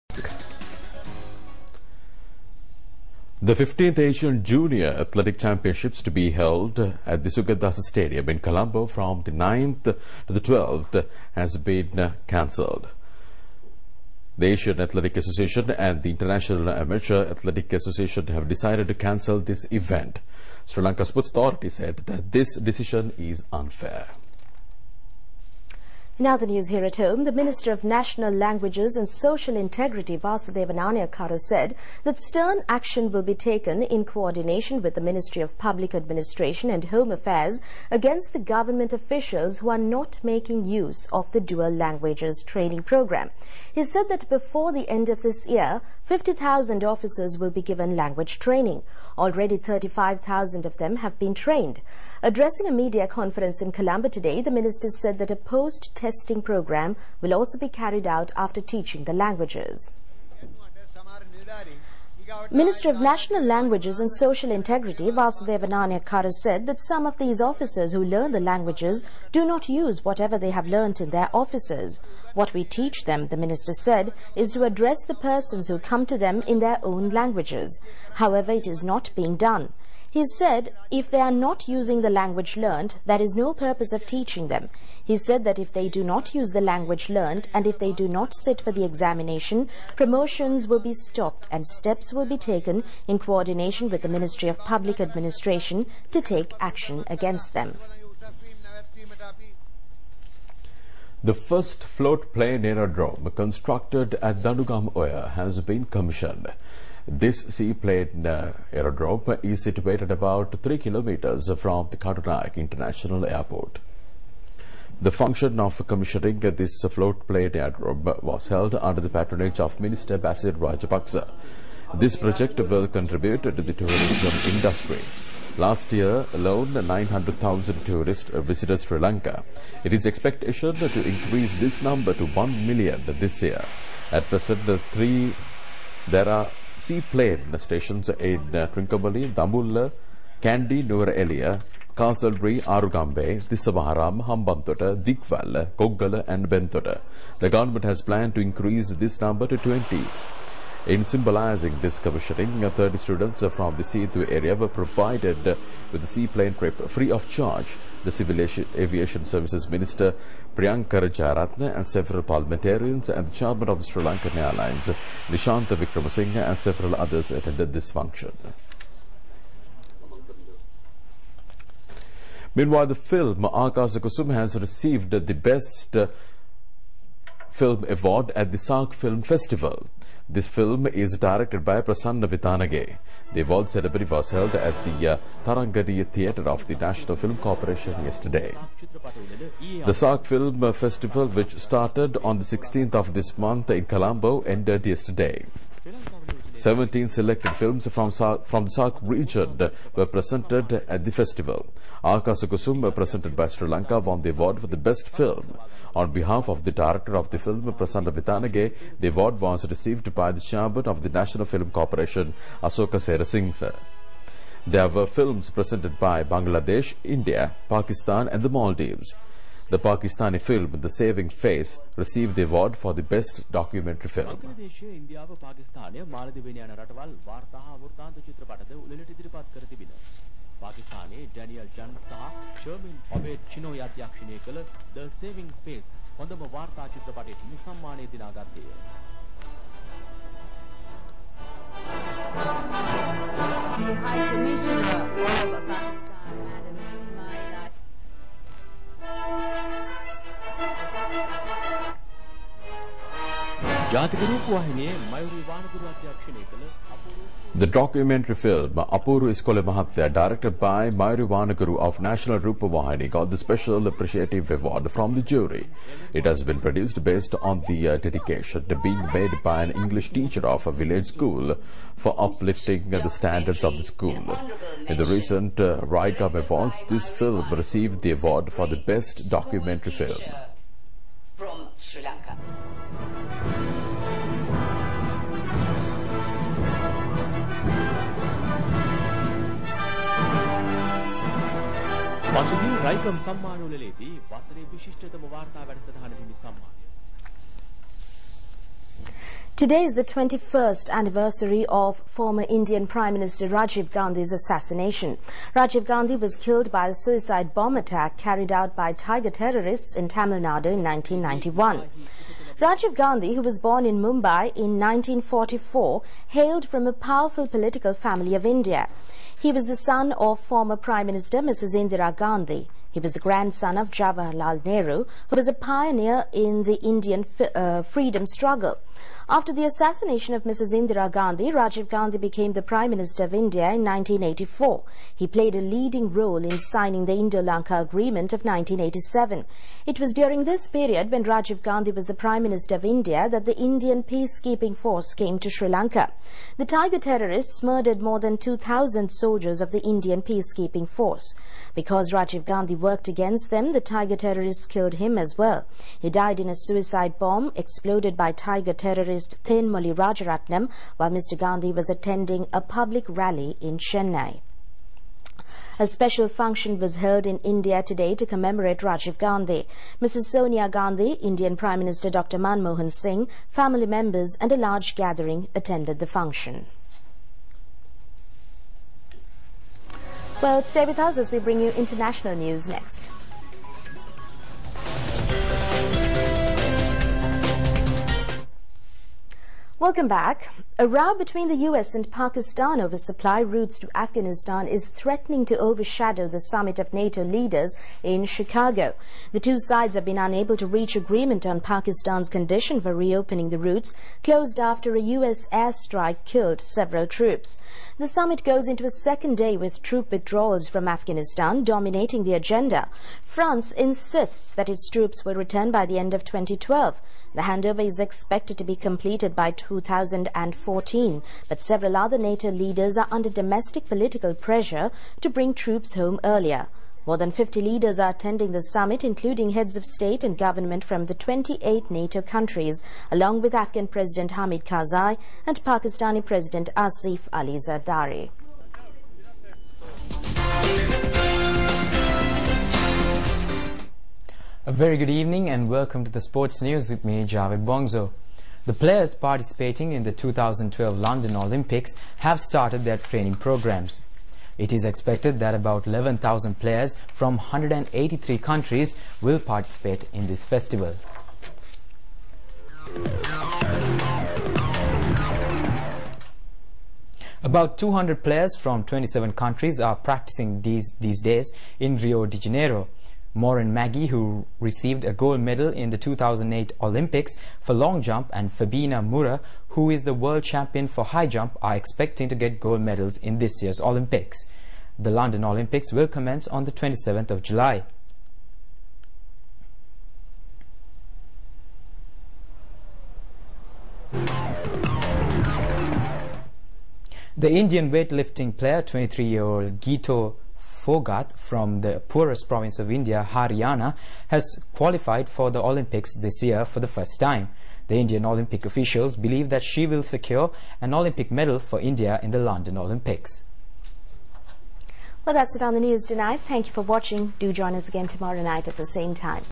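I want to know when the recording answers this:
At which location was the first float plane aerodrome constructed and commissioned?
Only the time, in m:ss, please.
1:44.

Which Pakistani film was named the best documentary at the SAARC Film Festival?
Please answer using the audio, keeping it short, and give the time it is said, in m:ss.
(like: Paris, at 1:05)
The Saving Face, at 3:40.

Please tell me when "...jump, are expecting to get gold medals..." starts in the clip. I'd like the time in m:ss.
8:01.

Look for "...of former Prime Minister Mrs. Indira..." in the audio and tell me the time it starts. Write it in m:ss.
5:20.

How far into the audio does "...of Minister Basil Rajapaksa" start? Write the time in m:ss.
1:59.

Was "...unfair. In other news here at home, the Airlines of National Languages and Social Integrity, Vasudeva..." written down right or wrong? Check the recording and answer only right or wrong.
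wrong.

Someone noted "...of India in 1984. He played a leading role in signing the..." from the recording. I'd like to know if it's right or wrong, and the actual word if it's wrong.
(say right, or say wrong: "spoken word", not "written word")
right.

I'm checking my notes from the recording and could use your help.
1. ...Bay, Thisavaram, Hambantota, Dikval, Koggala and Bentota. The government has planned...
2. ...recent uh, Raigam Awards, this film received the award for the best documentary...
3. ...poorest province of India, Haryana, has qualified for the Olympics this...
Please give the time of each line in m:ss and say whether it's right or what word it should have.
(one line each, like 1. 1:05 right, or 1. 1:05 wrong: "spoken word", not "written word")
1. 2:23 right
2. 4:35 right
3. 8:22 right.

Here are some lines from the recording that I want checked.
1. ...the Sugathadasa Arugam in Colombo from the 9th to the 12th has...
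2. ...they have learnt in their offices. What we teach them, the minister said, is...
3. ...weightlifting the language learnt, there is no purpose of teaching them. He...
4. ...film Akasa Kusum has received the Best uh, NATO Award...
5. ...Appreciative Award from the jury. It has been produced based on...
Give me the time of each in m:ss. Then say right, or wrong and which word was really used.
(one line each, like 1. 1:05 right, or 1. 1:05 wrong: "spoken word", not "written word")
1. 0:07 wrong: "Stadium", not "Arugam"
2. 1:10 right
3. 1:21 wrong: "using", not "weightlifting"
4. 2:52 wrong: "Film", not "NATO"
5. 4:23 right.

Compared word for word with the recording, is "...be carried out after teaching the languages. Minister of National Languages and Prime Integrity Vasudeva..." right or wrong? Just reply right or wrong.
wrong.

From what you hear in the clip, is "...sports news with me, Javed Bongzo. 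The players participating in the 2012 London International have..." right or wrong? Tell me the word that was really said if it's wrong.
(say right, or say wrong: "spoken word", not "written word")
wrong: "Olympics", not "International".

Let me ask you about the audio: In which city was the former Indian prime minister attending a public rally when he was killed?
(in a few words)
Chennai.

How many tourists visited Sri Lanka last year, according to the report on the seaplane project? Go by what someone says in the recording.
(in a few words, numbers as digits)
900,000.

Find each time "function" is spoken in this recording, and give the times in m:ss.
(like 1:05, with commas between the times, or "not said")
1:55, 2:47, 6:06, 6:16.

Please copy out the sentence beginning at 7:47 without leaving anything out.
About 200 players from 27 countries are practicing these, these days in Rio de Janeiro.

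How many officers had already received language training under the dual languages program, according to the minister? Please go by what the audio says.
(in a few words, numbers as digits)
35,000.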